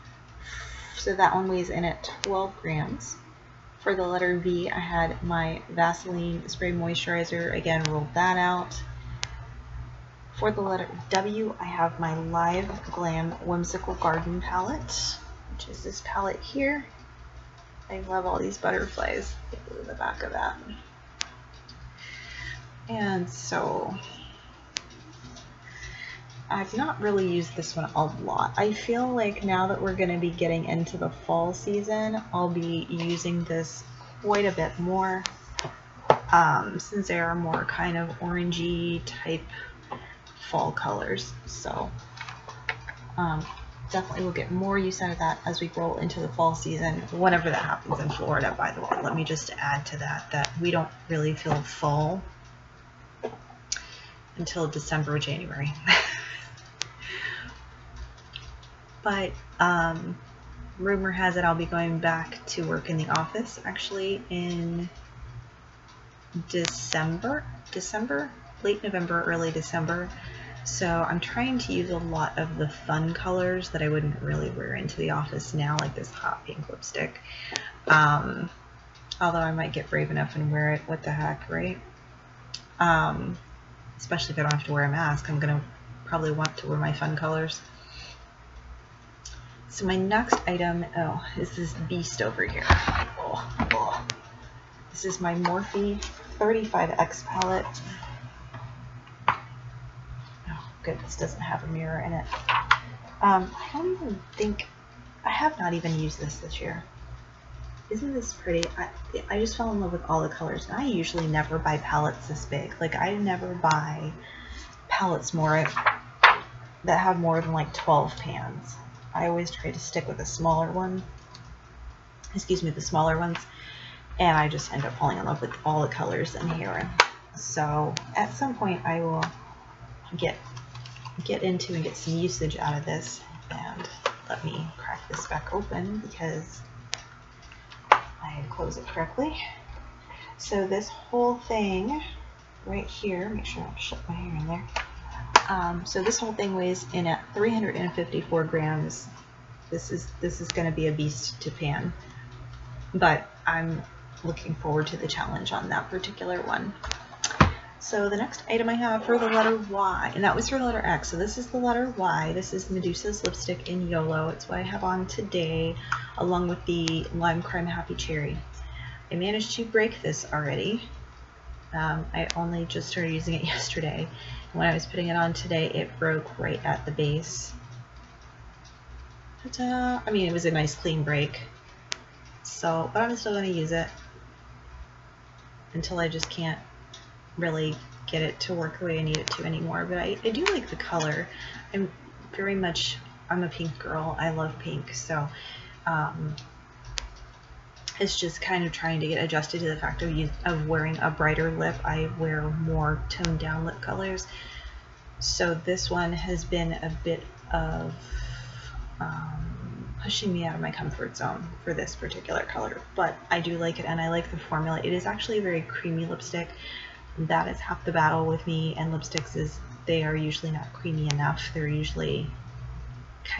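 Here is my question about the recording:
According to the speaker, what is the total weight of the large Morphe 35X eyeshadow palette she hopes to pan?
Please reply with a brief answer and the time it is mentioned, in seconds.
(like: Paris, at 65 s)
354 grams, at 147 s.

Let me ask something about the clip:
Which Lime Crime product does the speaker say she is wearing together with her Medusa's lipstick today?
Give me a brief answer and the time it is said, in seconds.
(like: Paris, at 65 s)
Happy Cherry, at 167 s.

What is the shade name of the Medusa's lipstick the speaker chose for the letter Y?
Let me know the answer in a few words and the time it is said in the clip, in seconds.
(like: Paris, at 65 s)
YOLO, at 163 s.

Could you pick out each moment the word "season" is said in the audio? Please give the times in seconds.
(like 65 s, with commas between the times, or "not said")
31 s, 46 s.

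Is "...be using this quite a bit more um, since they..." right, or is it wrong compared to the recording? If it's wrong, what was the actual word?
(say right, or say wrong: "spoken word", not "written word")
right.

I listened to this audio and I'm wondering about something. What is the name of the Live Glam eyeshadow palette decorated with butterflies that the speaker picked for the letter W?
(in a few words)
Whimsical Garden.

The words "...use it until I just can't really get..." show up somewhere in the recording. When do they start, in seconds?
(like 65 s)
183 s.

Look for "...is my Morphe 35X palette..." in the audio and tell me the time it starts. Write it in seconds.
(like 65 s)
95 s.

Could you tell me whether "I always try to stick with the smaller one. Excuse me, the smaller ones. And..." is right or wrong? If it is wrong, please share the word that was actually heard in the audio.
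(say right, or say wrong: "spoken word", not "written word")
right.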